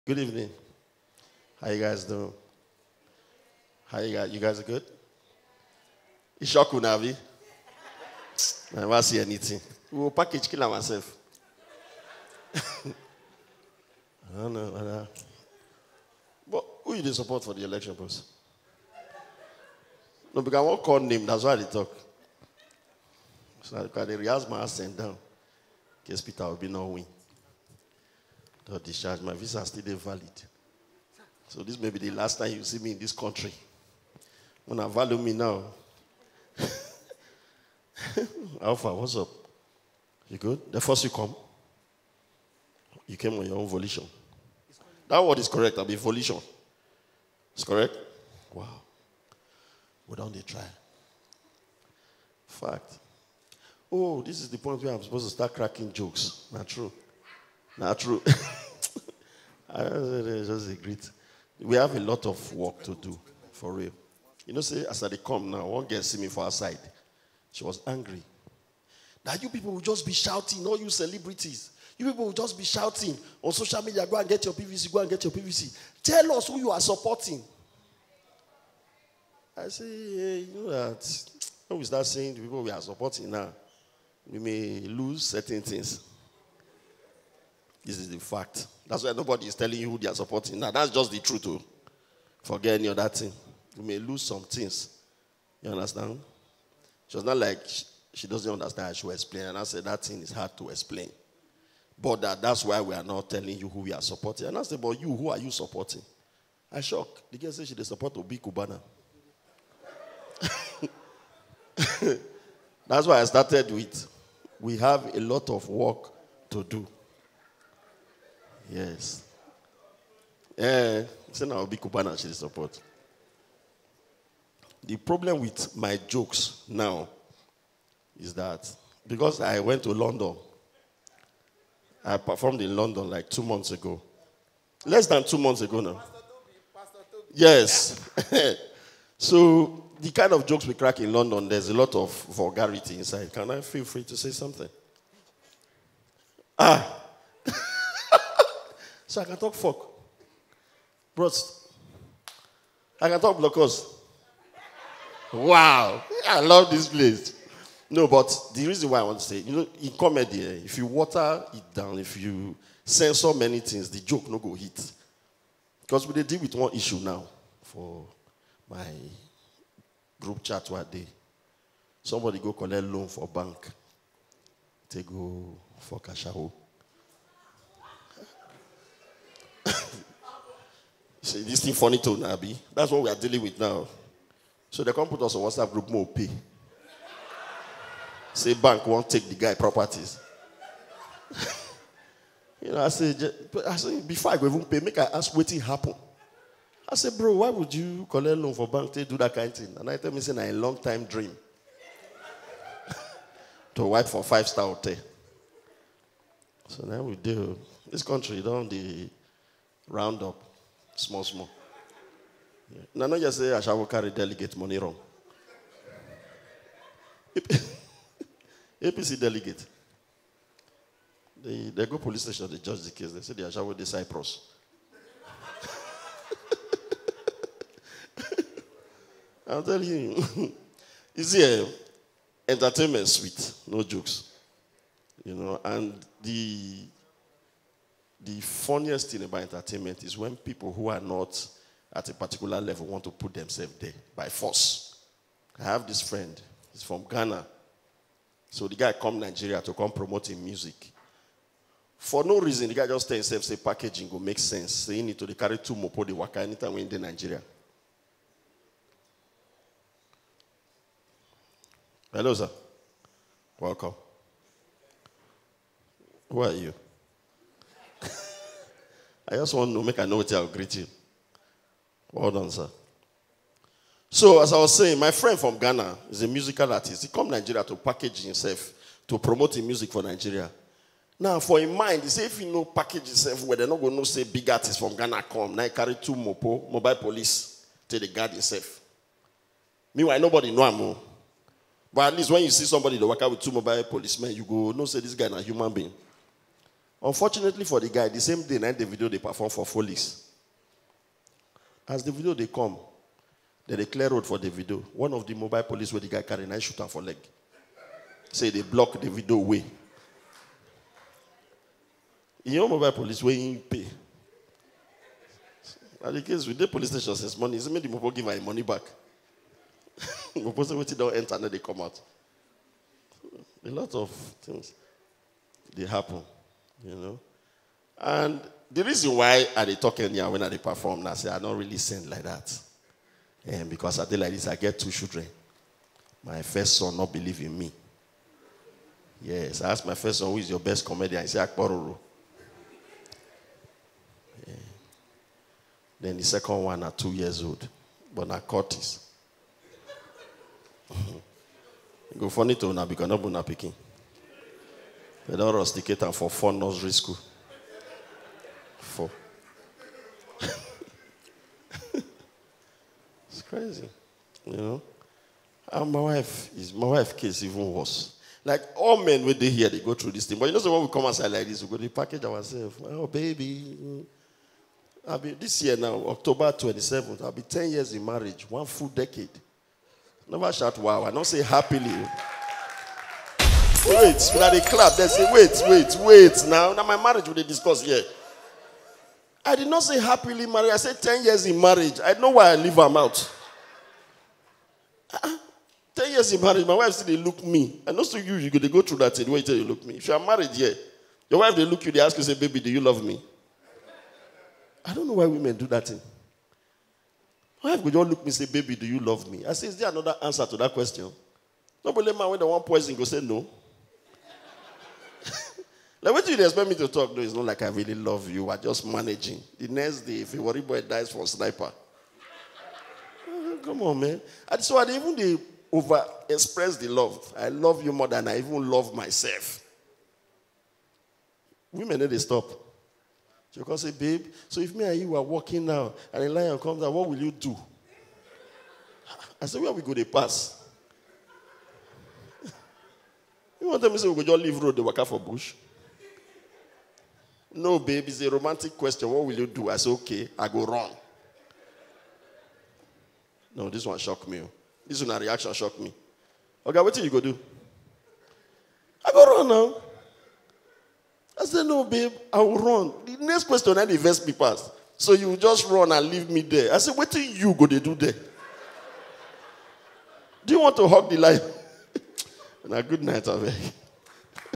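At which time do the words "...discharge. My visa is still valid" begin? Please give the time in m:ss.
0:28.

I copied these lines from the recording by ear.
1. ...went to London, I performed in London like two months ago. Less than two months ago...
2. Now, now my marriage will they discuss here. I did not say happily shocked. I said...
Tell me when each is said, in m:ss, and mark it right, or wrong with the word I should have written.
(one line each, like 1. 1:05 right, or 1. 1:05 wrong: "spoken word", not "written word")
1. 2:09 right
2. 6:26 wrong: "married", not "shocked".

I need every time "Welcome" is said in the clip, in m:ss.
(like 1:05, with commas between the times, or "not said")
4:23.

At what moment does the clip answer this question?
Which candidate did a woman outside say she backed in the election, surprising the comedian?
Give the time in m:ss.
1:48.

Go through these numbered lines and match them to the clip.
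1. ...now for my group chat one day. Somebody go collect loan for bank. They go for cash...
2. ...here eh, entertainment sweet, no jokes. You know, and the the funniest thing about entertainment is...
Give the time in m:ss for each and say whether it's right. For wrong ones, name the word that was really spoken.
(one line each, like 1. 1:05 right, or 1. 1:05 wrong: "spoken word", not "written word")
1. 2:46 right
2. 3:51 right.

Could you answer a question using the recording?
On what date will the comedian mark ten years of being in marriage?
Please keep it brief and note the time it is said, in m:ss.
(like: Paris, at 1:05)
October 27th, at 6:16.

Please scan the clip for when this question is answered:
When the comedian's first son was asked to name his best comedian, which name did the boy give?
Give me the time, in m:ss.
5:41.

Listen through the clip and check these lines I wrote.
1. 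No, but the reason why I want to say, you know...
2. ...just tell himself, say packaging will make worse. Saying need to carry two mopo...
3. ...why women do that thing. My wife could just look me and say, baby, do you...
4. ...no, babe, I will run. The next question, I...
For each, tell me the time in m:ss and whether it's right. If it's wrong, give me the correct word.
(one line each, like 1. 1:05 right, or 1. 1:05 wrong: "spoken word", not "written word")
1. 2:37 right
2. 4:12 wrong: "sense", not "worse"
3. 6:45 right
4. 7:41 right.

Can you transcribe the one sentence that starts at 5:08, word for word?
Say they block the video way.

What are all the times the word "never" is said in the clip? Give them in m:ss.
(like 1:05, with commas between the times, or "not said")
0:08, 6:20.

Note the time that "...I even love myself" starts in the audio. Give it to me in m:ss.
7:08.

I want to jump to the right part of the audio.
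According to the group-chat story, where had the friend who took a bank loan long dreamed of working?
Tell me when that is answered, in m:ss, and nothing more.
3:24.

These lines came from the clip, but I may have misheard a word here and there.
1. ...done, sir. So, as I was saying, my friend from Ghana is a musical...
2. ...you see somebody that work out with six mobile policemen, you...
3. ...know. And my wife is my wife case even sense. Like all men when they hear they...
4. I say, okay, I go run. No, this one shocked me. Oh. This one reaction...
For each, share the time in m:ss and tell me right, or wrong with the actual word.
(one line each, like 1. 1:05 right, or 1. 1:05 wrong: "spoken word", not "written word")
1. 4:32 right
2. 4:52 wrong: "two", not "six"
3. 6:04 wrong: "worse", not "sense"
4. 7:29 right.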